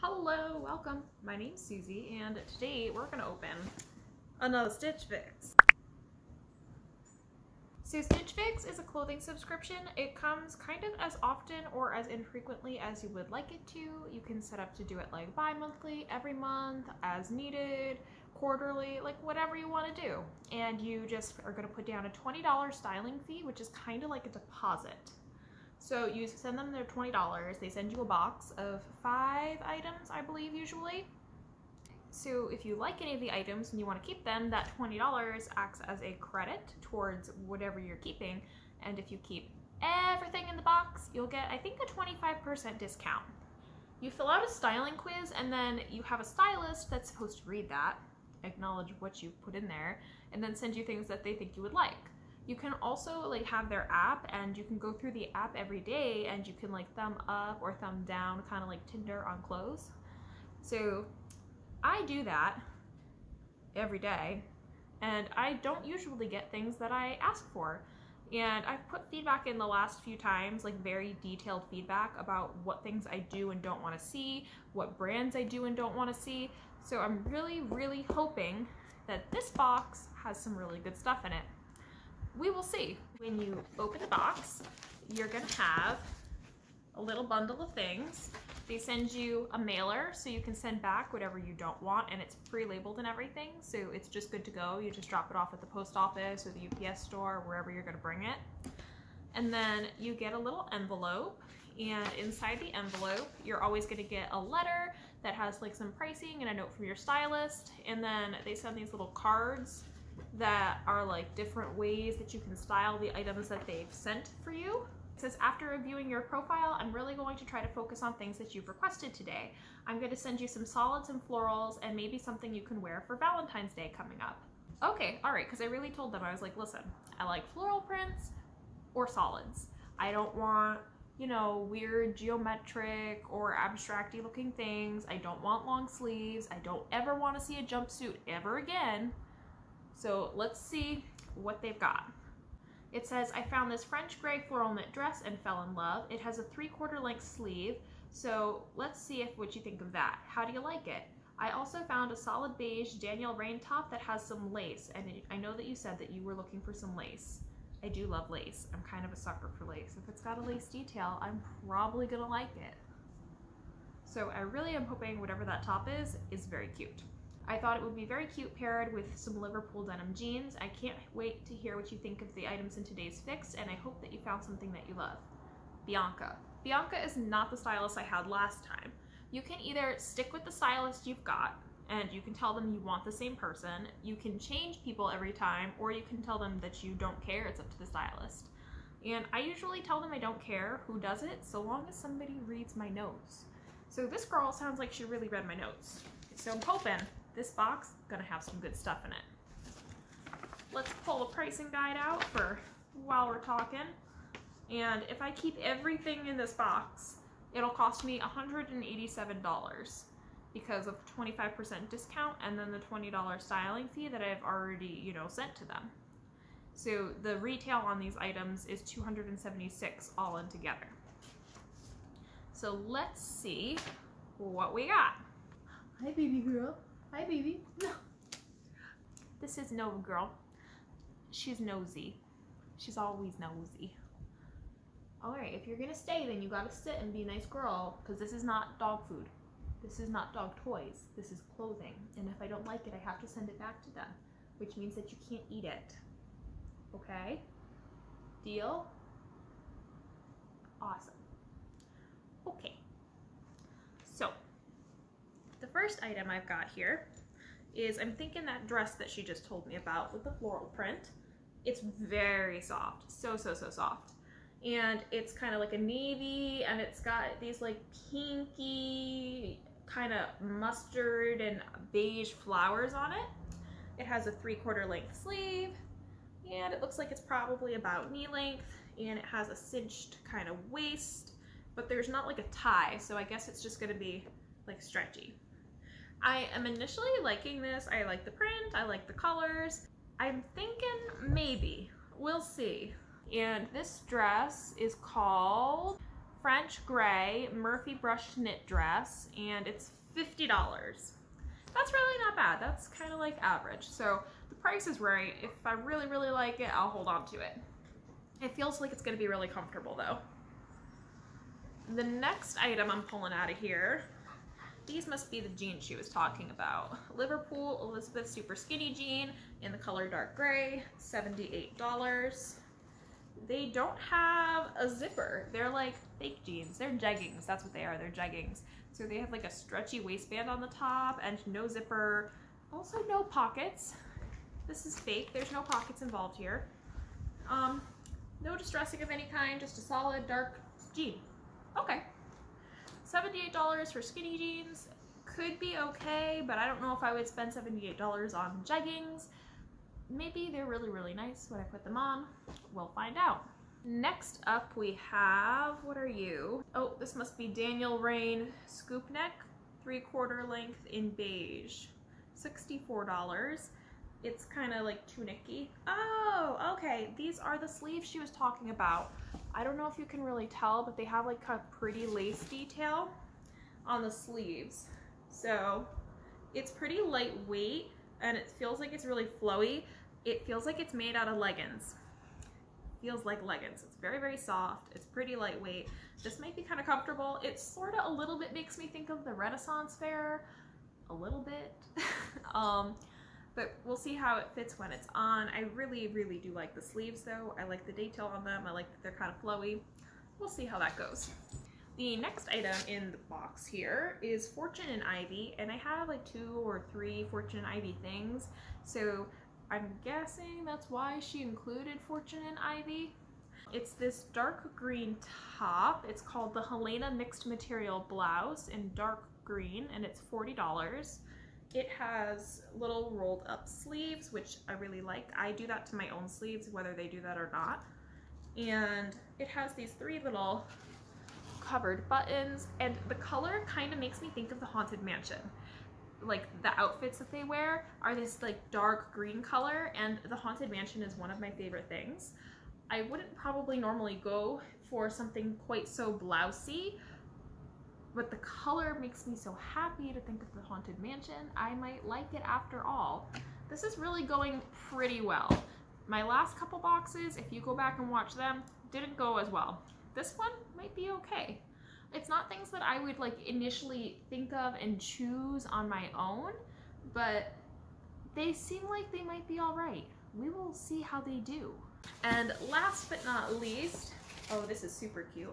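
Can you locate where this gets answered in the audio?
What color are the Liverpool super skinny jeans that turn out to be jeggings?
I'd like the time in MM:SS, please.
05:20.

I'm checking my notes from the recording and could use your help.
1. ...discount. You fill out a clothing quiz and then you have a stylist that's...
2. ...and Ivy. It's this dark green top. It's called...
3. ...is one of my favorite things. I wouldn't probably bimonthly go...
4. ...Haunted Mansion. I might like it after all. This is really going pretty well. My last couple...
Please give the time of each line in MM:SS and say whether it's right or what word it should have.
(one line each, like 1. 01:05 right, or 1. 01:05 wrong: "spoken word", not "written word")
1. 00:42 wrong: "styling", not "clothing"
2. 06:52 right
3. 07:21 wrong: "normally", not "bimonthly"
4. 07:30 right.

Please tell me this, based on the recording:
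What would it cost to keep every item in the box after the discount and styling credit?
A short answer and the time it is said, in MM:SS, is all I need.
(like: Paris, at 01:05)
$187, at 03:28.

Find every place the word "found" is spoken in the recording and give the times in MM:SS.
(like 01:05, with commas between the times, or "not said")
02:23, 02:31, 02:54.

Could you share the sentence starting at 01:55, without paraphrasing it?
It says, after reviewing your profile, I'm really going to try to focus on things that you've requested today.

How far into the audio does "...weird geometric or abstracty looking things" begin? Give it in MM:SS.
02:11.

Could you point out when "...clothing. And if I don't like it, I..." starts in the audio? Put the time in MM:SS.
04:01.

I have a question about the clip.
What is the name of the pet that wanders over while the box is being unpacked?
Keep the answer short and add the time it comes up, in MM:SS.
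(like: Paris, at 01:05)
Nova, at 03:49.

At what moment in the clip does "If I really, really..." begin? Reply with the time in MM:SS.
05:05.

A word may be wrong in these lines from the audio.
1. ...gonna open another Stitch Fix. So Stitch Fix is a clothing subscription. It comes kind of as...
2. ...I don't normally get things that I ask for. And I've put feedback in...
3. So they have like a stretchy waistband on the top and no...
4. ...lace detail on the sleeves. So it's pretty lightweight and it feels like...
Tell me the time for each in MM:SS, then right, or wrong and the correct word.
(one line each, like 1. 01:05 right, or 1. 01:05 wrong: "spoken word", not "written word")
1. 00:03 right
2. 01:05 wrong: "usually", not "normally"
3. 05:28 right
4. 06:12 right.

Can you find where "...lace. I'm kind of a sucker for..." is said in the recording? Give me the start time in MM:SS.
02:38.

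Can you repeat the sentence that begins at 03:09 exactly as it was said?
And I usually tell them I don't care who does it, so long as somebody reads my notes.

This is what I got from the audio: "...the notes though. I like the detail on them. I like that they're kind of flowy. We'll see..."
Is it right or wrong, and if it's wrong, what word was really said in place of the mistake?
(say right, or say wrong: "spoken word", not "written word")
wrong: "sleeves", not "notes".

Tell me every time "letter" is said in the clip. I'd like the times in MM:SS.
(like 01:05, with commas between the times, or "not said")
01:44.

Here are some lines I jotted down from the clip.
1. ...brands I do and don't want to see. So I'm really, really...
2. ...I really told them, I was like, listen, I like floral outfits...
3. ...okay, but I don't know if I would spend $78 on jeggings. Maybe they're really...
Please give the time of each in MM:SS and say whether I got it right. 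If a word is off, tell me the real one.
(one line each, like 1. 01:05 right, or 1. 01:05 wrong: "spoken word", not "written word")
1. 01:14 right
2. 02:05 wrong: "prints", not "outfits"
3. 05:45 right.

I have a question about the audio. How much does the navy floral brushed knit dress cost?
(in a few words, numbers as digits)
$50.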